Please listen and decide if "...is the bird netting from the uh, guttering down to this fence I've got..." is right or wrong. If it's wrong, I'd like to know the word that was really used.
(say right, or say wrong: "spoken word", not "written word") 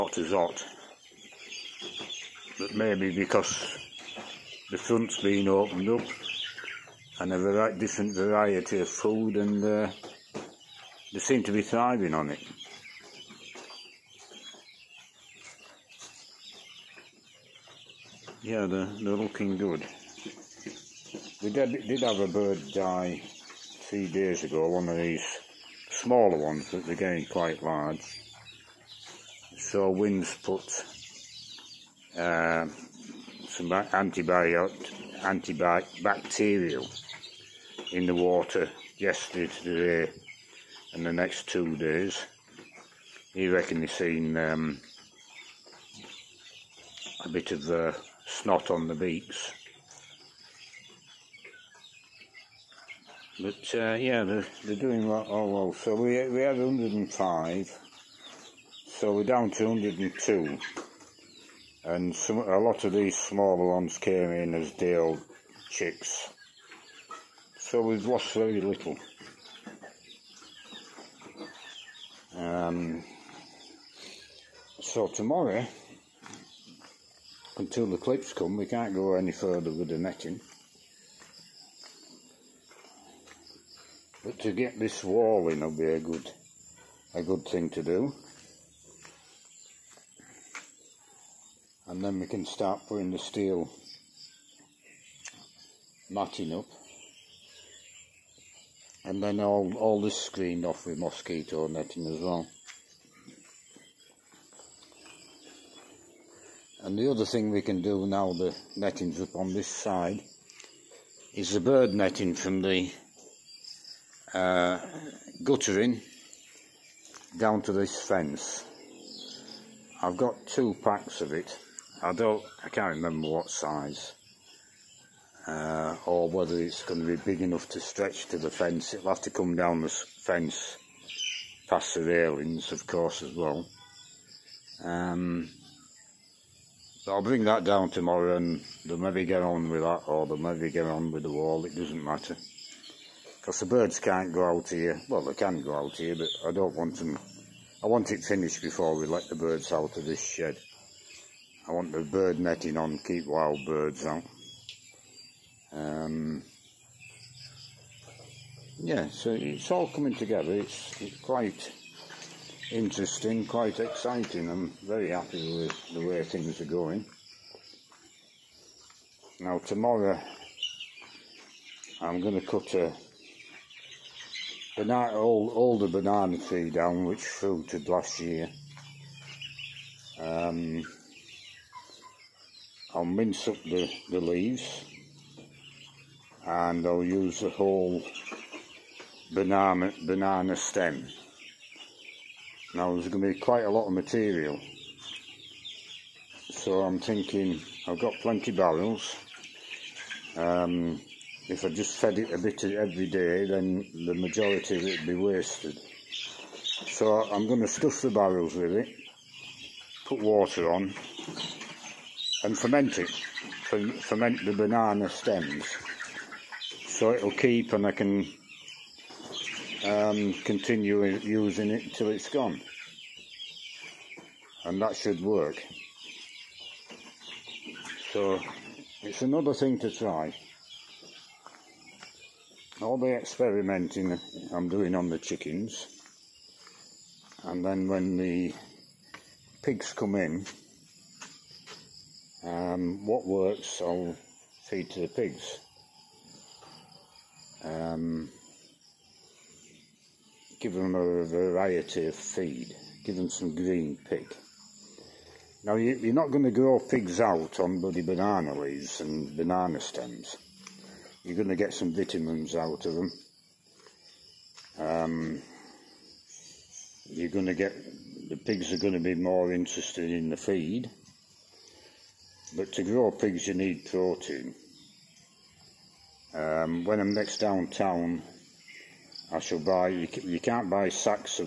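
right.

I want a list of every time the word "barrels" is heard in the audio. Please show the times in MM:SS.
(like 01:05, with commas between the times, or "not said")
03:18, 03:28.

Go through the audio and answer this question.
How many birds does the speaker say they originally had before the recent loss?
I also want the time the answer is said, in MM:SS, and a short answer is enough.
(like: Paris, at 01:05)
105, at 00:56.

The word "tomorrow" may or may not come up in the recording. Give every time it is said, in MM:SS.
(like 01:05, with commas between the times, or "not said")
01:15, 02:17, 02:49.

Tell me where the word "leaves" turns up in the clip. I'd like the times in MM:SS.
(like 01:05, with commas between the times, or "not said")
03:04, 04:18.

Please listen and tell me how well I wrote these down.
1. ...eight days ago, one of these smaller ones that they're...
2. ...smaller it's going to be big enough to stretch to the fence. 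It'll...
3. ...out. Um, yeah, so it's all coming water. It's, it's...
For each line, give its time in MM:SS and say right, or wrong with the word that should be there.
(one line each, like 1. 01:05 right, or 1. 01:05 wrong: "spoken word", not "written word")
1. 00:23 wrong: "three", not "eight"
2. 02:06 wrong: "whether", not "smaller"
3. 02:34 wrong: "together", not "water".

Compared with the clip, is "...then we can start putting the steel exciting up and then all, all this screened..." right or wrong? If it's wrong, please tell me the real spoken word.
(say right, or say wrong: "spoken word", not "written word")
wrong: "matting", not "exciting".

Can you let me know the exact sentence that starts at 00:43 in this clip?
He reckon he's seen um, a bit of uh, snot on the beaks.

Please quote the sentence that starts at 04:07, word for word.
Um, give them a variety of feed.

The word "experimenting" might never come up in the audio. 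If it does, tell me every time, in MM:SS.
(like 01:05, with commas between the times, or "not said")
03:53.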